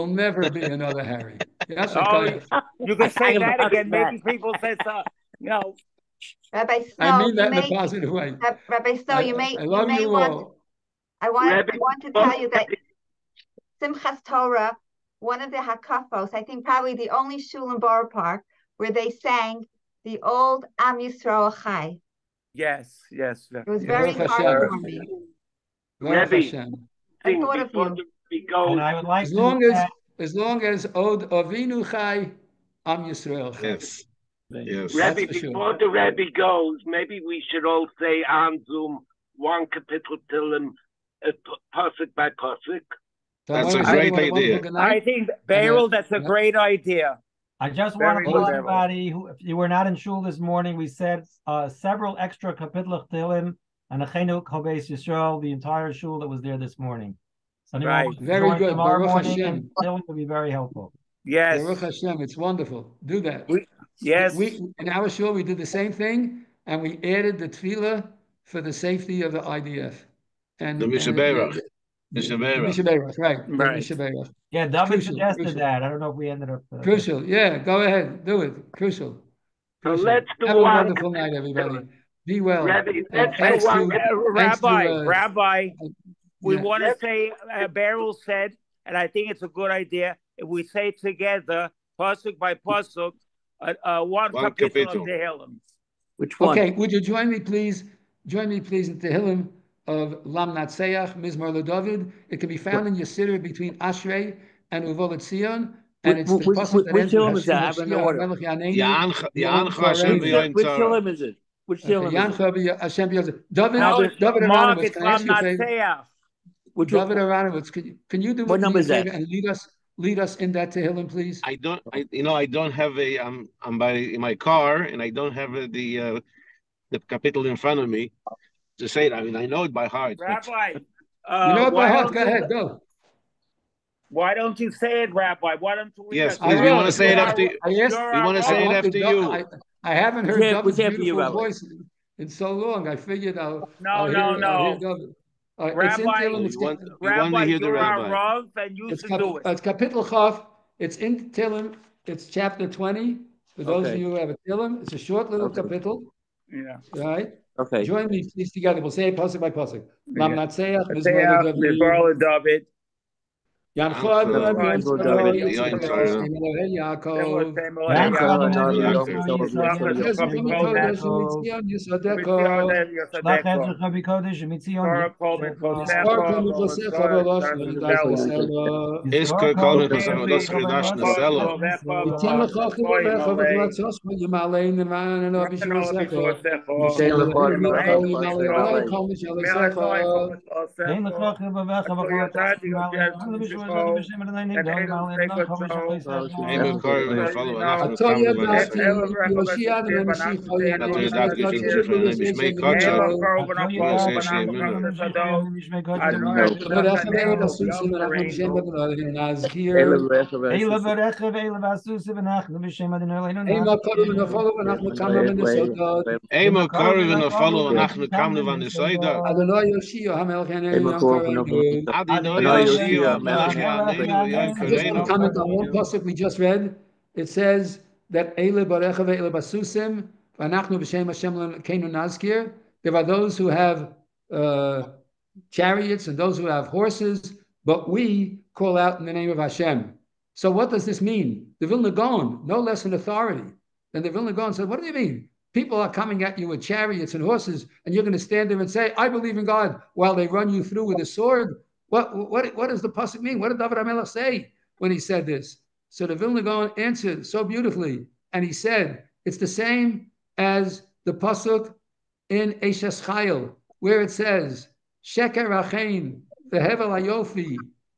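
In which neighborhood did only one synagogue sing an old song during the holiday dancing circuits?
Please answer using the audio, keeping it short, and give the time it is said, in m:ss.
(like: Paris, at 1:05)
Borough Park, at 0:17.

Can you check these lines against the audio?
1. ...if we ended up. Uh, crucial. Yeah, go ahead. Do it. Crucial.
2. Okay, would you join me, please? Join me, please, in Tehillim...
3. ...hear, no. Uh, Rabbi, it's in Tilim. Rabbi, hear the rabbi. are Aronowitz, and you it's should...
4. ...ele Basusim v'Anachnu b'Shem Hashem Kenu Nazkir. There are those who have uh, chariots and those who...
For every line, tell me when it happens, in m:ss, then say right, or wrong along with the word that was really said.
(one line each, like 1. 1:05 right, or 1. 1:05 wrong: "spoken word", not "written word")
1. 1:16 right
2. 1:36 right
3. 2:24 wrong: "Rav", not "Aronowitz"
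4. 3:49 right.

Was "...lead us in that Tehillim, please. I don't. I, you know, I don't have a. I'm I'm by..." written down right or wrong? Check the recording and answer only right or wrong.
right.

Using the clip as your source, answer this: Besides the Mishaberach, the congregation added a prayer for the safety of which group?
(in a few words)
the IDF.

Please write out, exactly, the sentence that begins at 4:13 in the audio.
What did David HaMelech say when he said this?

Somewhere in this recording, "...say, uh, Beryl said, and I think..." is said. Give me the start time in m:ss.
1:27.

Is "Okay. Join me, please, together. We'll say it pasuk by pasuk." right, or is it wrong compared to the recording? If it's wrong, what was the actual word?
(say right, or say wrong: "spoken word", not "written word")
right.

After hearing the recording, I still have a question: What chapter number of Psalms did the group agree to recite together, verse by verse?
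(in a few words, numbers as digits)
20.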